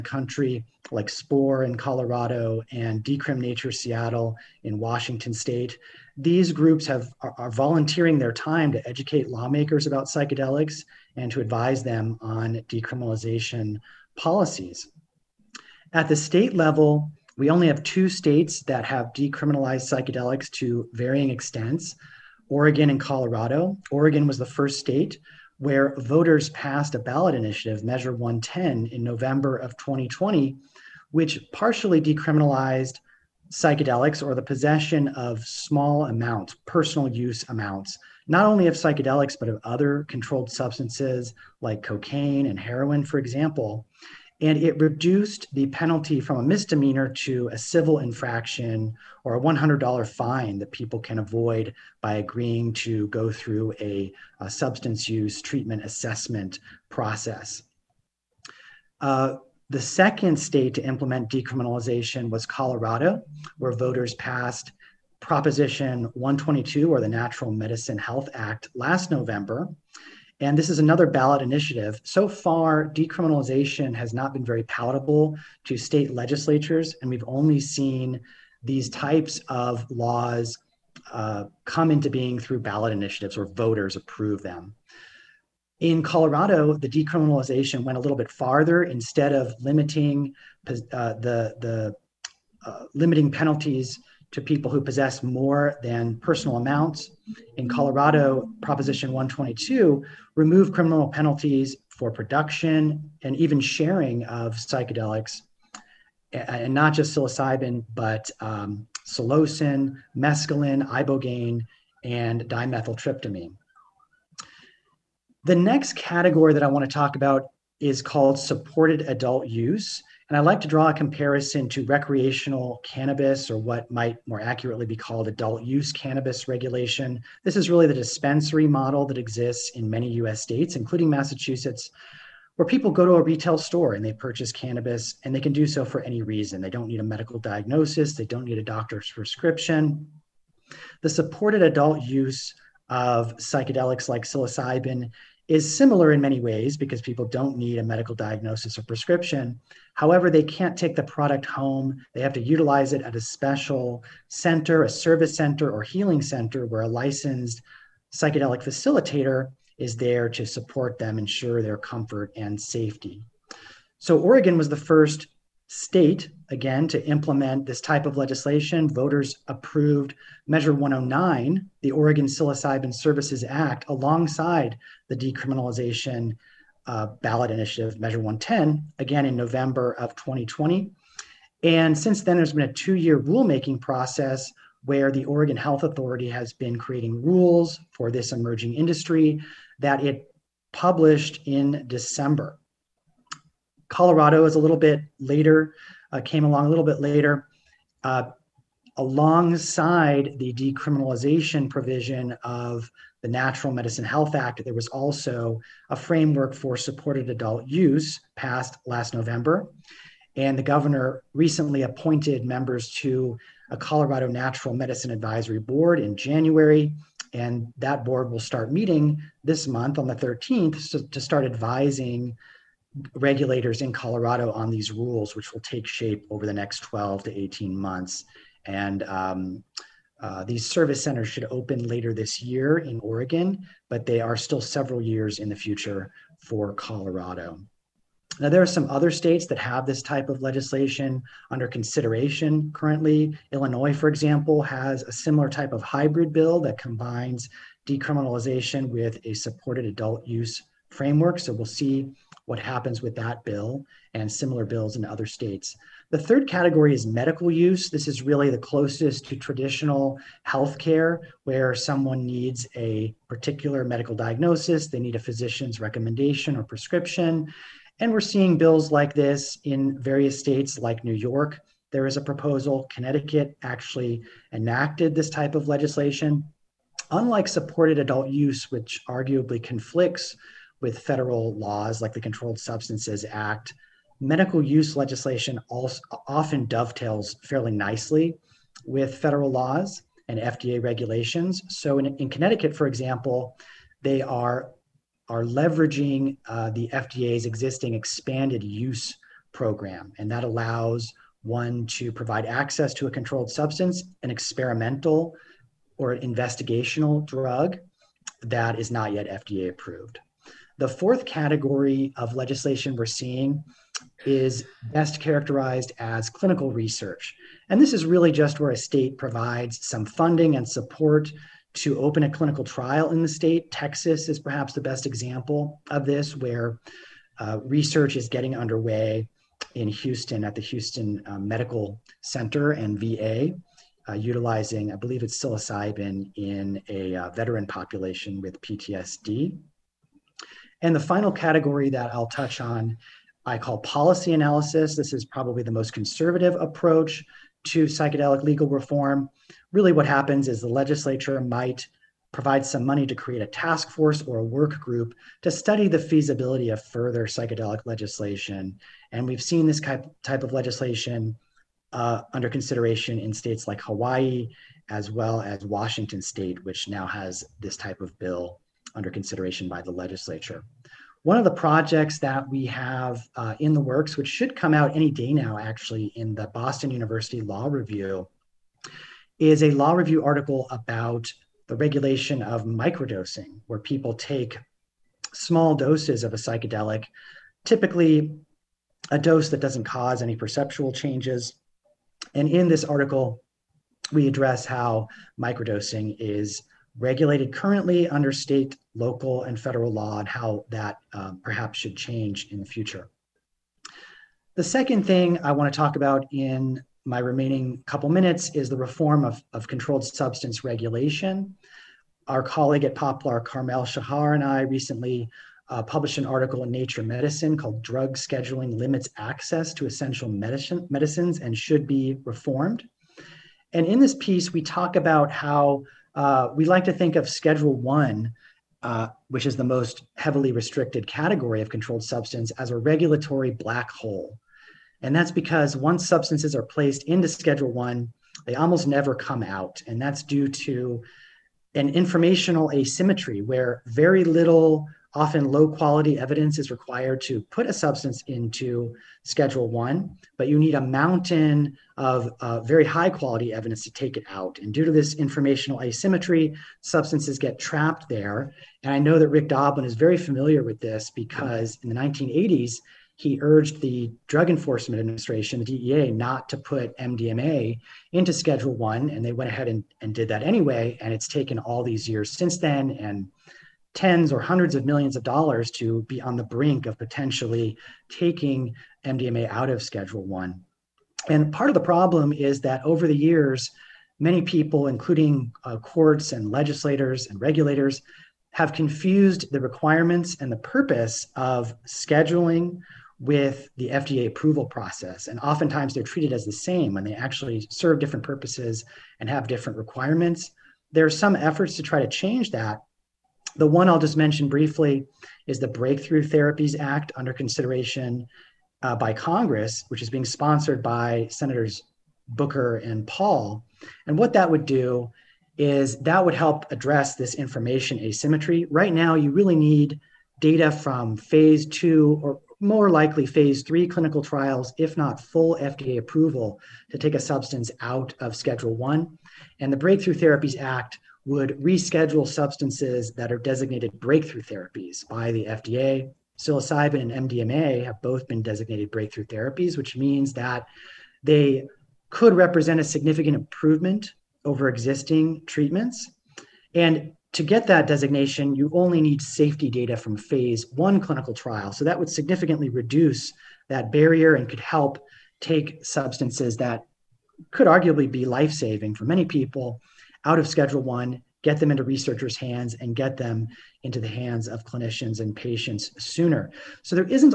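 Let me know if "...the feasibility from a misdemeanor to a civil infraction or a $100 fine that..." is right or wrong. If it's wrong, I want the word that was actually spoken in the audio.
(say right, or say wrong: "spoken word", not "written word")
wrong: "penalty", not "feasibility".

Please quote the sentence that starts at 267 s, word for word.
And we're seeing bills like this in various states like New York.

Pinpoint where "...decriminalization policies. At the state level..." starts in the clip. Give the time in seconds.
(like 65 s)
12 s.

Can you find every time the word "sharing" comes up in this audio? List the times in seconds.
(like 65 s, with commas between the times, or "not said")
103 s.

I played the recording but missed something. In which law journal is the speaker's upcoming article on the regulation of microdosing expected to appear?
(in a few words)
Boston University Law Review.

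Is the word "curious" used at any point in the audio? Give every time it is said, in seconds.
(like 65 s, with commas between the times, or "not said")
not said.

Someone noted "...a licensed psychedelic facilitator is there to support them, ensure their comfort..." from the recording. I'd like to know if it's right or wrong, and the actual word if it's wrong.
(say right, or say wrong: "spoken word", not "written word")
right.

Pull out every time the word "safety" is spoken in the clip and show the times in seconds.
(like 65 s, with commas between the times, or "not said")
162 s, 549 s.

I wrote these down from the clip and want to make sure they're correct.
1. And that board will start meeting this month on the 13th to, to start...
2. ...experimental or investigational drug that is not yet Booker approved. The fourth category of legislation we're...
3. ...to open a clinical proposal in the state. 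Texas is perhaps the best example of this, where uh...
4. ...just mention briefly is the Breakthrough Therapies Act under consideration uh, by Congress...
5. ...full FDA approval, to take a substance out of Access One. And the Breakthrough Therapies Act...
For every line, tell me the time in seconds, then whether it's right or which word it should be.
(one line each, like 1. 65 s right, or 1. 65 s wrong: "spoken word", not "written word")
1. 217 s right
2. 304 s wrong: "FDA", not "Booker"
3. 321 s wrong: "trial", not "proposal"
4. 503 s right
5. 525 s wrong: "Schedule", not "Access".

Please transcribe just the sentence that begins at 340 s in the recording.
And the final category that I'll touch on, I call policy analysis.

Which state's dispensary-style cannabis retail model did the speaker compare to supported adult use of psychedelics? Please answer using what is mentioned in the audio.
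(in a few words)
Massachusetts.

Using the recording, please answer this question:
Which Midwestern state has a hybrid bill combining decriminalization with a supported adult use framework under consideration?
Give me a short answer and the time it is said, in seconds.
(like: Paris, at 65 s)
Illinois, at 243 s.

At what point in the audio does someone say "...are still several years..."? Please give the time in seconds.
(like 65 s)
234 s.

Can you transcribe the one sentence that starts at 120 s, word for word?
And I like to draw a comparison to recreational cannabis, or what might more accurately be called adult use cannabis regulation.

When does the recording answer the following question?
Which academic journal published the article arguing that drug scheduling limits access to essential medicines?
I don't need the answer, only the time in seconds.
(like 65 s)
416 s.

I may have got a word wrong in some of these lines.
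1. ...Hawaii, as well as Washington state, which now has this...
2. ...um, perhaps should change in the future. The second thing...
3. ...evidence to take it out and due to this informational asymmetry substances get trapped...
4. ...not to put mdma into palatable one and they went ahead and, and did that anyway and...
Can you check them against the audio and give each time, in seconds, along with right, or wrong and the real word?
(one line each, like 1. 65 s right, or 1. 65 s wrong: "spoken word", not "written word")
1. 363 s right
2. 401 s right
3. 453 s right
4. 466 s wrong: "schedule", not "palatable".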